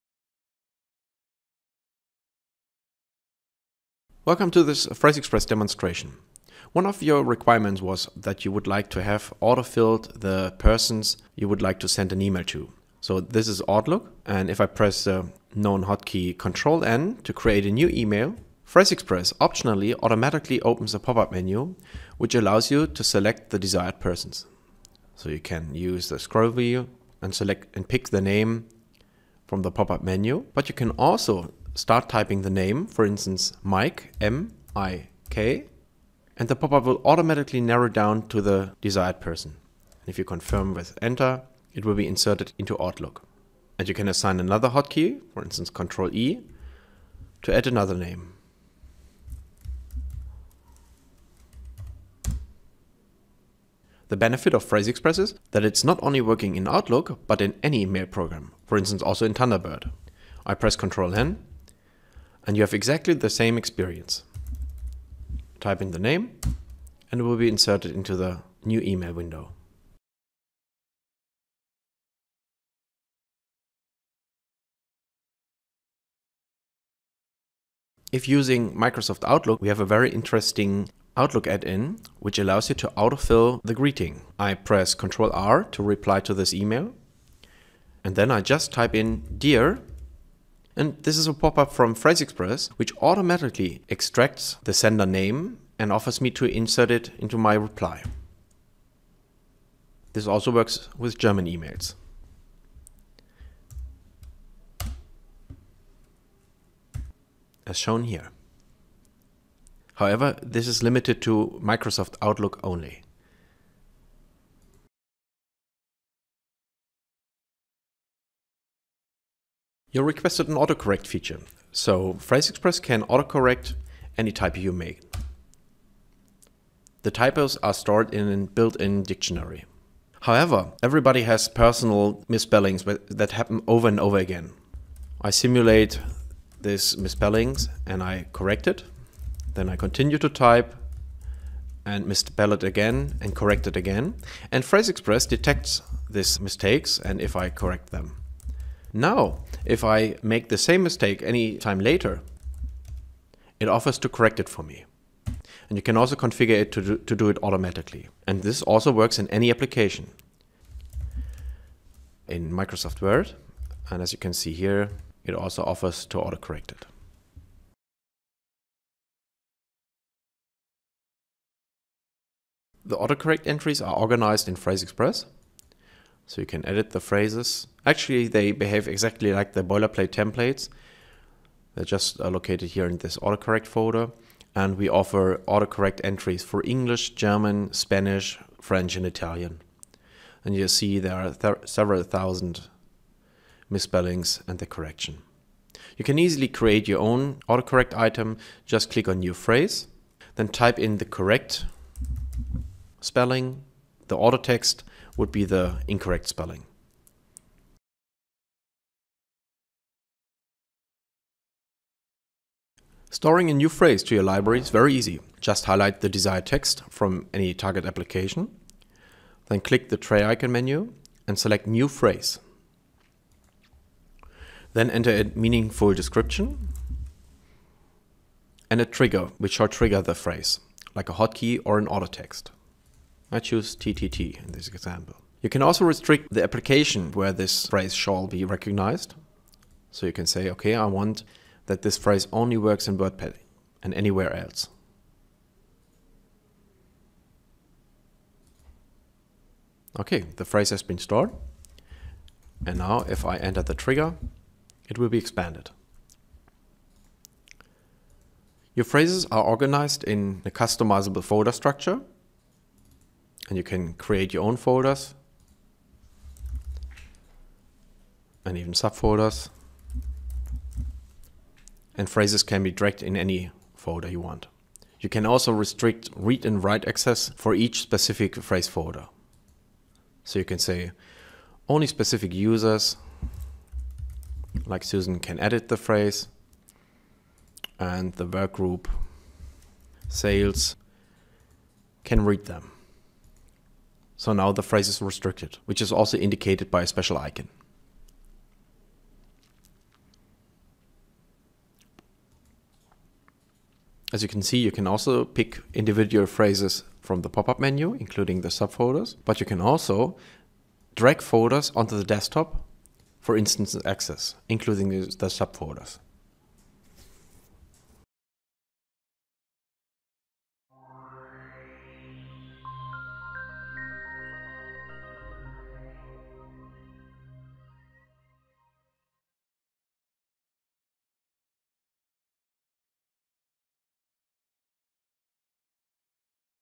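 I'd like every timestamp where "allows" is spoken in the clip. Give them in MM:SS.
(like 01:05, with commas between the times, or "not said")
00:22, 01:22.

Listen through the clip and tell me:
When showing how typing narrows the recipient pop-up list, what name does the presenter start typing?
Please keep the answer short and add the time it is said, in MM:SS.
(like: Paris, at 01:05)
Mike, at 00:33.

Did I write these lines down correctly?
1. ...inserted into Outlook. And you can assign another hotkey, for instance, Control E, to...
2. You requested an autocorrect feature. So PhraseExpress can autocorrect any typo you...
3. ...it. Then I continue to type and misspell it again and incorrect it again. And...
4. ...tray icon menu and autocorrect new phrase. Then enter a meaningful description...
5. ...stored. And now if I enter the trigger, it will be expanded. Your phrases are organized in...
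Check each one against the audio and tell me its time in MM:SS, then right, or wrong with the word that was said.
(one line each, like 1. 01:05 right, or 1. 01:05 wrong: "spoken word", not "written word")
1. 00:42 right
2. 01:59 right
3. 02:18 wrong: "correct", not "incorrect"
4. 03:40 wrong: "select", not "autocorrect"
5. 04:10 right.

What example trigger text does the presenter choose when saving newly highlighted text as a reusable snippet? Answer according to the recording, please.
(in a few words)
TTT.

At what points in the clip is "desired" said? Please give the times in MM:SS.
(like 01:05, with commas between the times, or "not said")
00:23, 00:38, 03:36.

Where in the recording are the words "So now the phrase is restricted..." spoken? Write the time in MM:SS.
04:54.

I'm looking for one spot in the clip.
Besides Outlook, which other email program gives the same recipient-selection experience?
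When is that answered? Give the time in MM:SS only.
00:59.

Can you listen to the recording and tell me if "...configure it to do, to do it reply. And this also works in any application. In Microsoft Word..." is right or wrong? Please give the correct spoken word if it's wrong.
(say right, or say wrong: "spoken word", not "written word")
wrong: "automatically", not "reply".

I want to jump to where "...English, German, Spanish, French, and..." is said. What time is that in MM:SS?
03:06.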